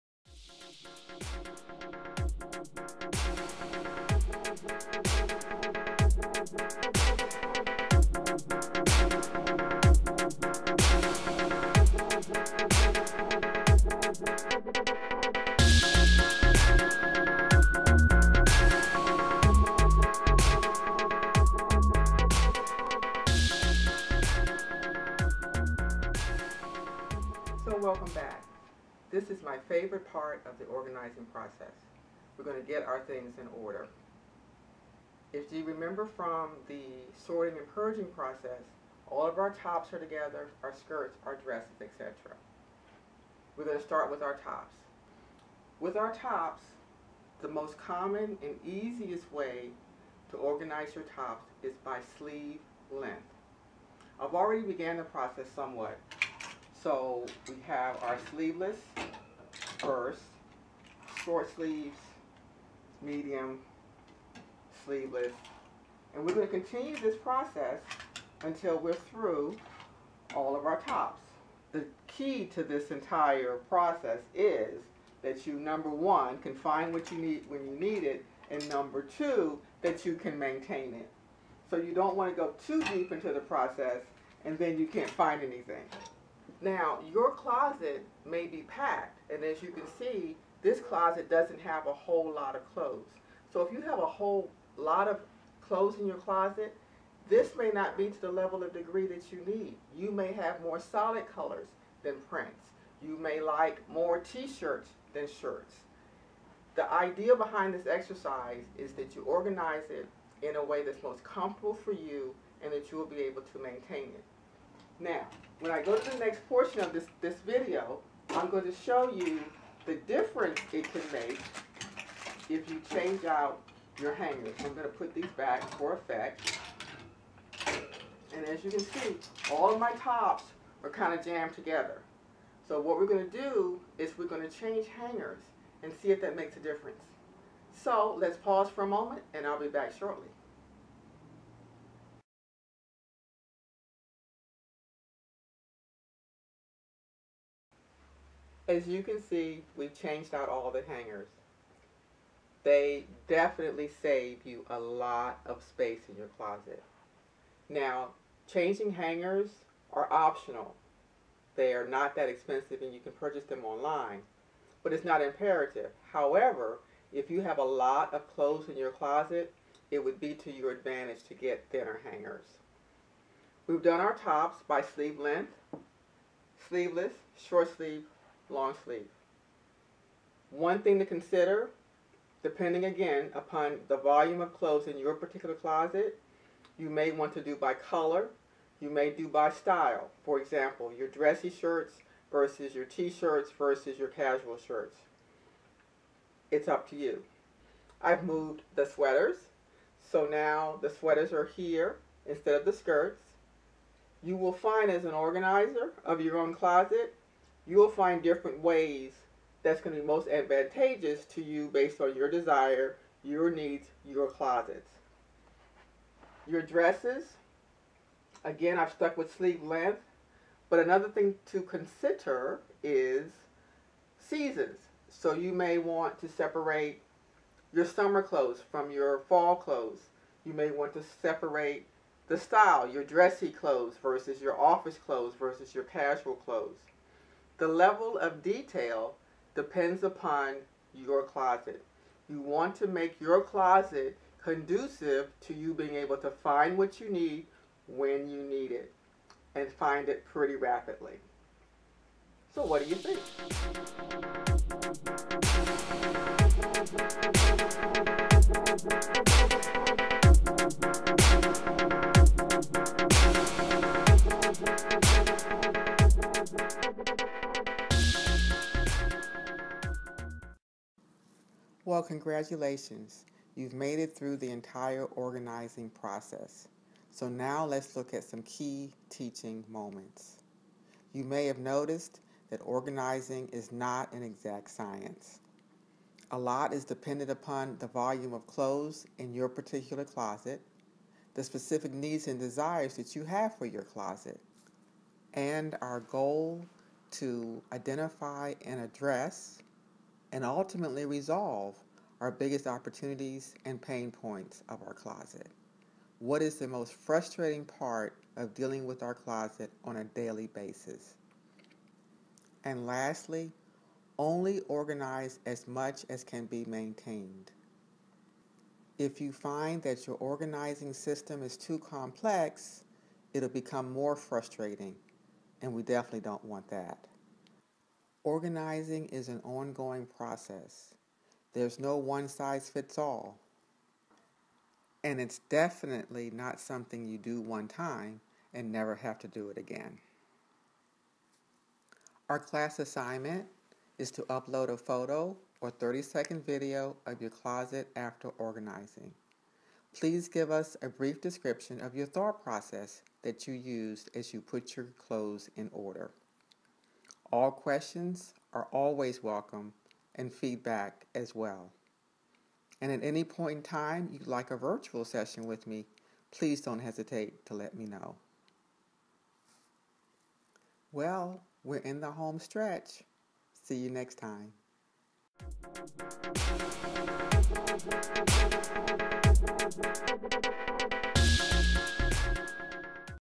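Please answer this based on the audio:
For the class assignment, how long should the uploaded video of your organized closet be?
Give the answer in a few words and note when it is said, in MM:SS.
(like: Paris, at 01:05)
30 seconds, at 05:45.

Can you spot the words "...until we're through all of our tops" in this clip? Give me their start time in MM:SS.
01:08.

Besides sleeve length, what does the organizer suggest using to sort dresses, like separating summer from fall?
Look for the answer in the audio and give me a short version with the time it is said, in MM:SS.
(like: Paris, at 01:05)
Seasons, at 03:44.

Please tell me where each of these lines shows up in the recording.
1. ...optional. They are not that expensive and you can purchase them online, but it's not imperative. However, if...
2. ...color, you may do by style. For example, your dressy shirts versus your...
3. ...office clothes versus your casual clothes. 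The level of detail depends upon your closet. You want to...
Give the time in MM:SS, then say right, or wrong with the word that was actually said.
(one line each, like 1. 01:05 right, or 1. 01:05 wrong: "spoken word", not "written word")
1. 02:40 right
2. 03:07 right
3. 03:54 right.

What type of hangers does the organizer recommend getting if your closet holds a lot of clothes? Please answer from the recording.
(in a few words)
Thinner hangers.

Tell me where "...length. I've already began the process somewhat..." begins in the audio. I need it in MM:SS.
00:52.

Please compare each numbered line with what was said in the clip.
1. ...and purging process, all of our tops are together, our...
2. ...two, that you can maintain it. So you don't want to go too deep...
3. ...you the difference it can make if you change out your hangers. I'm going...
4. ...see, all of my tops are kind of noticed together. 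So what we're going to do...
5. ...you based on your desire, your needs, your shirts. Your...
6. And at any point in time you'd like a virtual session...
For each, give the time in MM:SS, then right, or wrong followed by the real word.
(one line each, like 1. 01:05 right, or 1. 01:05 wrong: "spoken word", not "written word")
1. 00:37 right
2. 01:19 right
3. 01:59 right
4. 02:08 wrong: "jammed", not "noticed"
5. 03:31 wrong: "closets", not "shirts"
6. 06:02 right.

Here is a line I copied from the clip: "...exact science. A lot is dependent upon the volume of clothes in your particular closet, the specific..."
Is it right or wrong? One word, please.
right.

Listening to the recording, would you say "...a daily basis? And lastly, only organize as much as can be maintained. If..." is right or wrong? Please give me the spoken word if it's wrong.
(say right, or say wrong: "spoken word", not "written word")
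right.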